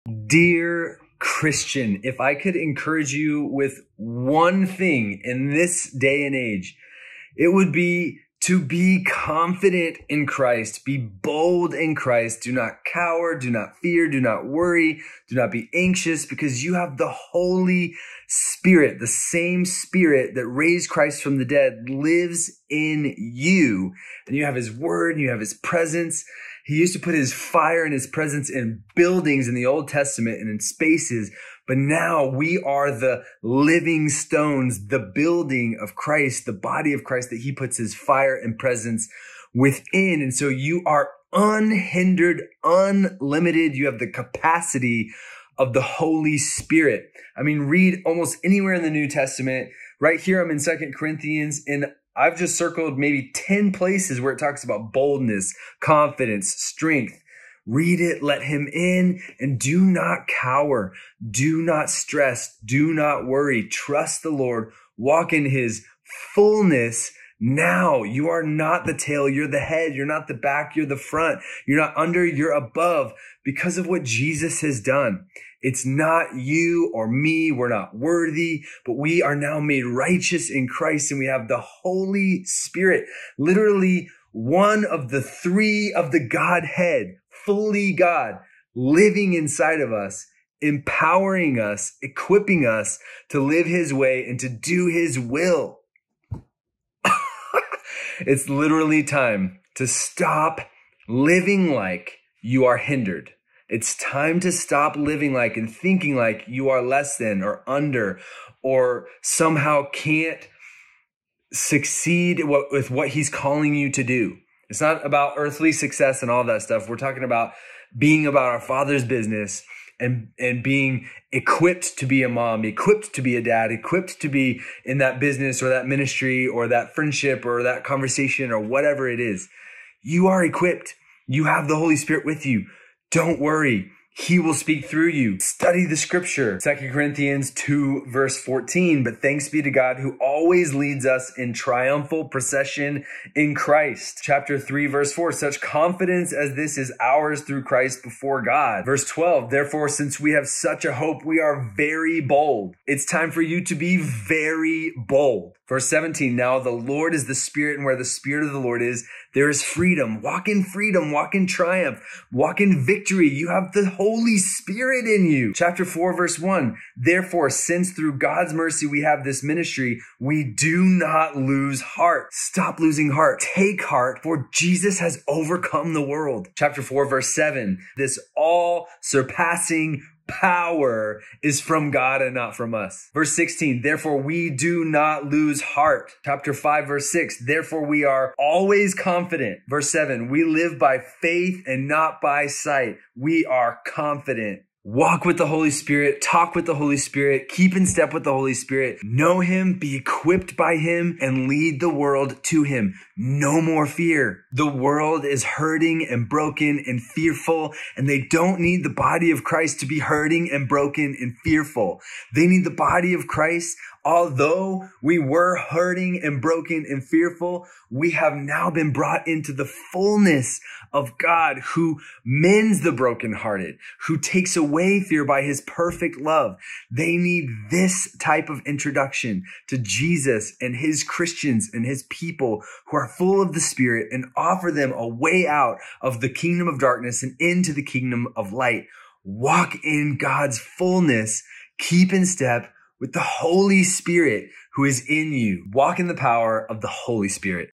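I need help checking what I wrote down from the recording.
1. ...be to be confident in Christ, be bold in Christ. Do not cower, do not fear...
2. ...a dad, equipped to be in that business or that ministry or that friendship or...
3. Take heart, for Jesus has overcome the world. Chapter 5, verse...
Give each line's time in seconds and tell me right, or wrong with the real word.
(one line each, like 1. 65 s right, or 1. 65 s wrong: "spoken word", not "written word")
1. 7 s right
2. 123 s right
3. 173 s wrong: "4", not "5".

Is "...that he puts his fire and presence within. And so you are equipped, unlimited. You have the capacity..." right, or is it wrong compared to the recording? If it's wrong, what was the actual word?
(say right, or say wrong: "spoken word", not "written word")
wrong: "unhindered", not "equipped".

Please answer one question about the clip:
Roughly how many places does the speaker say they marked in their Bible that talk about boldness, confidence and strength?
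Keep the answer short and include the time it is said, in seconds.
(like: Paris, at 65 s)
10, at 53 s.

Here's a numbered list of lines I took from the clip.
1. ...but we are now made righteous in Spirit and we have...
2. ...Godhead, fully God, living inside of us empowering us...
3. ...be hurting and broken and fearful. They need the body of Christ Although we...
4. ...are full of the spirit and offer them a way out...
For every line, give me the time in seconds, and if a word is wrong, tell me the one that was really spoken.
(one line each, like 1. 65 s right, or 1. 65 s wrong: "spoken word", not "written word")
1. 78 s wrong: "Christ", not "Spirit"
2. 86 s right
3. 209 s right
4. 232 s right.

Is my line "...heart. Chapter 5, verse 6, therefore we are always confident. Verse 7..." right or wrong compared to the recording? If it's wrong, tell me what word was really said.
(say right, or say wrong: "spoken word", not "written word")
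right.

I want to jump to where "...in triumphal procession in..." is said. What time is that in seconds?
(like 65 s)
141 s.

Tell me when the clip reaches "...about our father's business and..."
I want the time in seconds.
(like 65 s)
118 s.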